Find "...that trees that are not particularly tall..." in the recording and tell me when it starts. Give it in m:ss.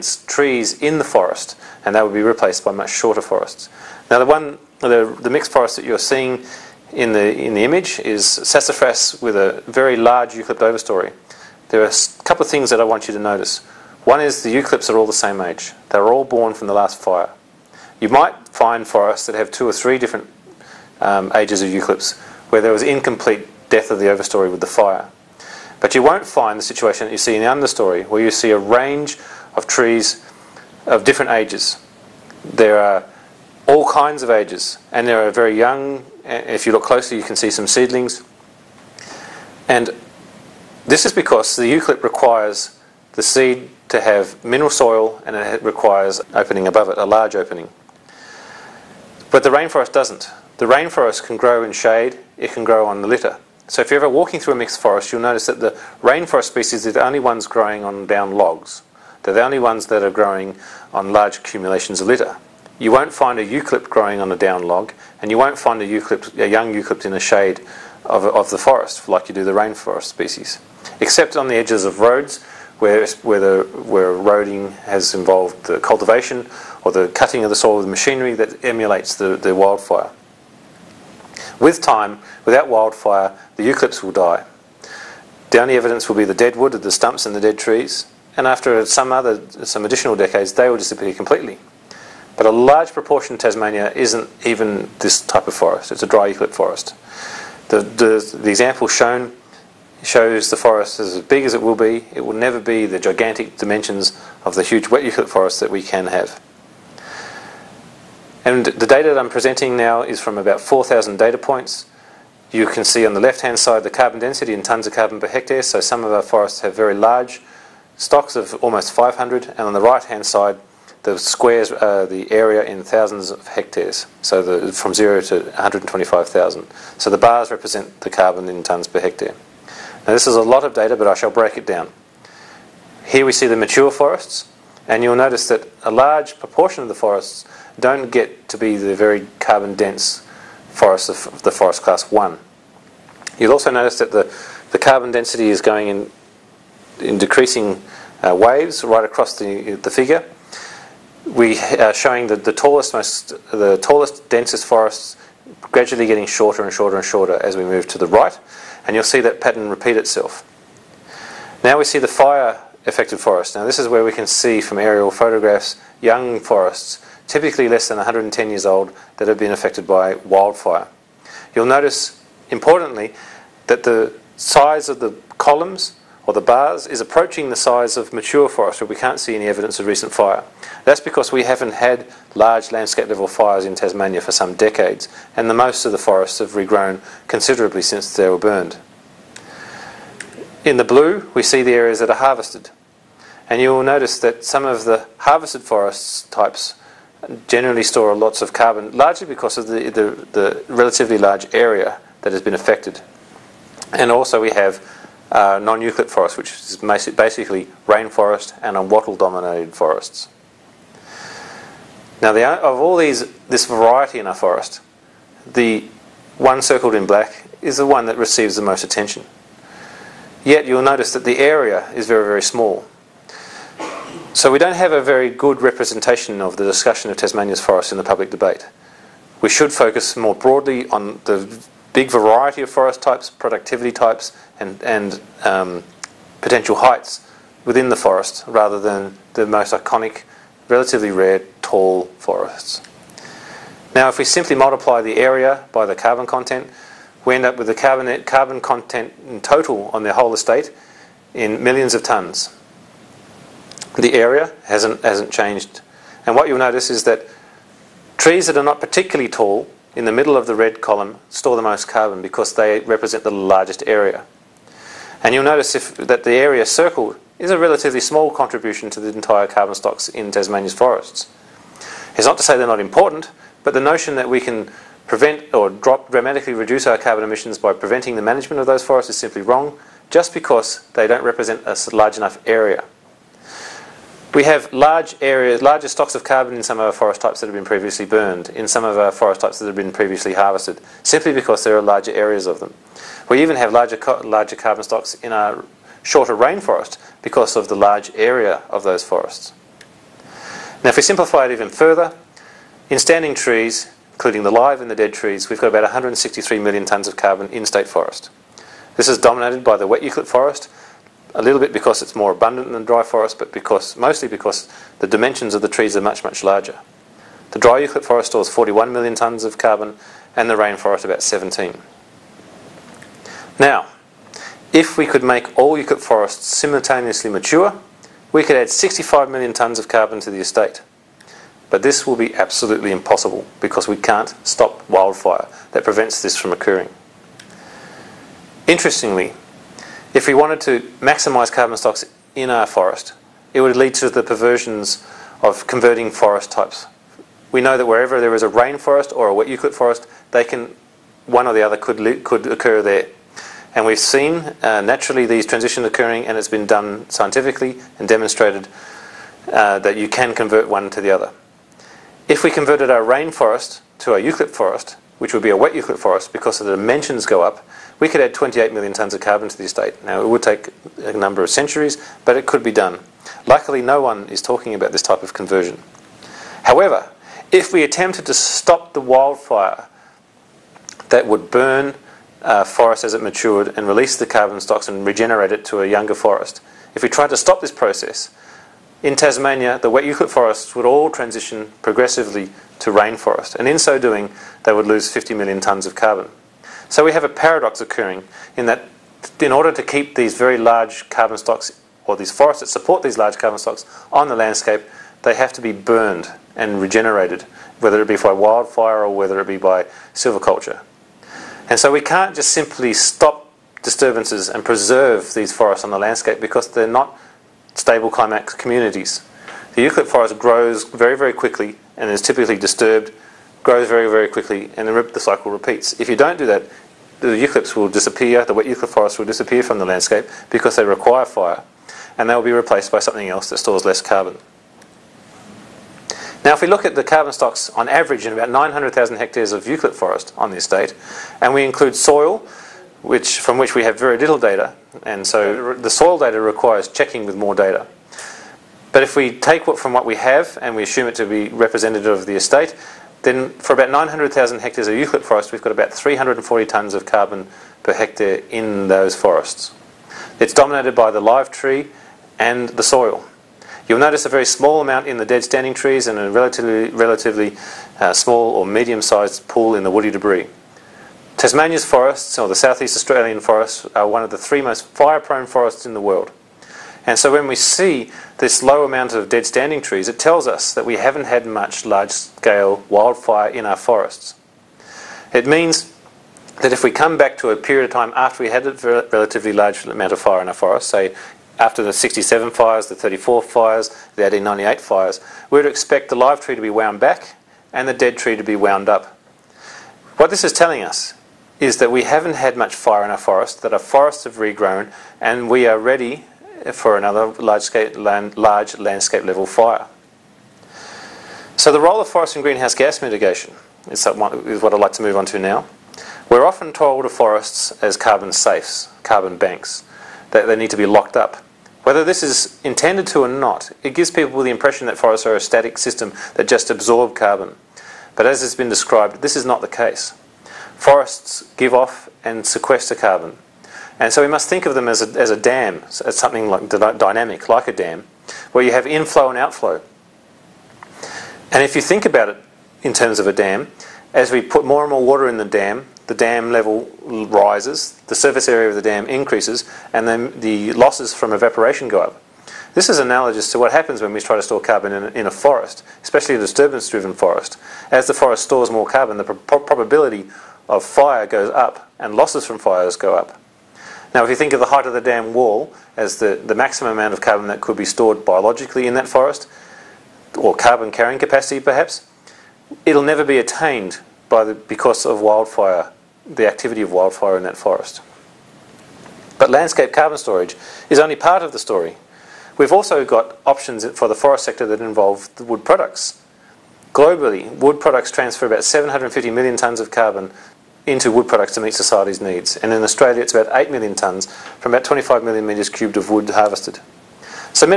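4:17.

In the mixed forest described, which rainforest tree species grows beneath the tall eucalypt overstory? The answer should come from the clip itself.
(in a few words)
Sassafras.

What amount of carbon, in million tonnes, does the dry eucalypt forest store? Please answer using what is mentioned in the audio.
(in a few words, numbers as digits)
41 million tonnes.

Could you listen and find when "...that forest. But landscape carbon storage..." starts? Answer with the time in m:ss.
9:37.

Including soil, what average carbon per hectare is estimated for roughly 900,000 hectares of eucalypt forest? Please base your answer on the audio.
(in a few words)
340 tonnes.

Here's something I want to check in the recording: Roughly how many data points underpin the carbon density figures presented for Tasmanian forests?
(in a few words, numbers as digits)
4,000.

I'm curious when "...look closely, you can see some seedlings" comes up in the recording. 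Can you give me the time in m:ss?
0:36.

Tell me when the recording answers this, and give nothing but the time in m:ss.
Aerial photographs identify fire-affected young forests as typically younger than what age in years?
2:47.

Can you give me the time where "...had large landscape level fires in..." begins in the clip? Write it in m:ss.
3:01.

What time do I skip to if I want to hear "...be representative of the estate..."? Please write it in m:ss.
7:31.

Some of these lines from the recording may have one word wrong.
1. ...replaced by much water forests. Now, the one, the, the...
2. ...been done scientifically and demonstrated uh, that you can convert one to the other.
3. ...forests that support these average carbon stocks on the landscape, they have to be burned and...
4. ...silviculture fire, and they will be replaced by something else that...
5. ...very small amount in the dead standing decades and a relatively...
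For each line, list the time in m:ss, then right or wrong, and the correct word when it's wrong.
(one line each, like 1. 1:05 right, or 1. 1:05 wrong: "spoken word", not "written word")
1. 0:02 wrong: "shorter", not "water"
2. 5:56 right
3. 6:42 wrong: "large", not "average"
4. 7:10 wrong: "require", not "silviculture"
5. 7:44 wrong: "trees", not "decades".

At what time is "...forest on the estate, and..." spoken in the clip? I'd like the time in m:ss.
7:19.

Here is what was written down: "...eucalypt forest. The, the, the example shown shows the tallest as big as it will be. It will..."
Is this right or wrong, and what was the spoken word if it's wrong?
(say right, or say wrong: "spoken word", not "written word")
wrong: "forest", not "tallest".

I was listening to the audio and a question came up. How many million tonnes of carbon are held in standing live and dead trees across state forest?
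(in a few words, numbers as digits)
163 million tonnes.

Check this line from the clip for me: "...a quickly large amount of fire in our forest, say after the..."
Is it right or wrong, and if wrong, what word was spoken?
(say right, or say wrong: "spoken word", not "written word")
wrong: "relatively", not "quickly".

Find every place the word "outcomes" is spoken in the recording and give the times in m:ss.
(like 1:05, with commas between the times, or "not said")
not said.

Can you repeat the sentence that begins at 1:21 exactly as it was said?
With time, without wildfire, the eucalypts will die.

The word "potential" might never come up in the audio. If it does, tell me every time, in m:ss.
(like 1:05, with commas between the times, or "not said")
3:56.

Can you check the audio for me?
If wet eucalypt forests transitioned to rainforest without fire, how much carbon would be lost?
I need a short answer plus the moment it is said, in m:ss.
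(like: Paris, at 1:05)
50 million tonnes, at 6:35.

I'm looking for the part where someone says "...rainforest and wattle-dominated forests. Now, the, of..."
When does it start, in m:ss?
3:27.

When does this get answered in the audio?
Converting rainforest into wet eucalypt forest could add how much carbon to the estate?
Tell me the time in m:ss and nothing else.
6:08.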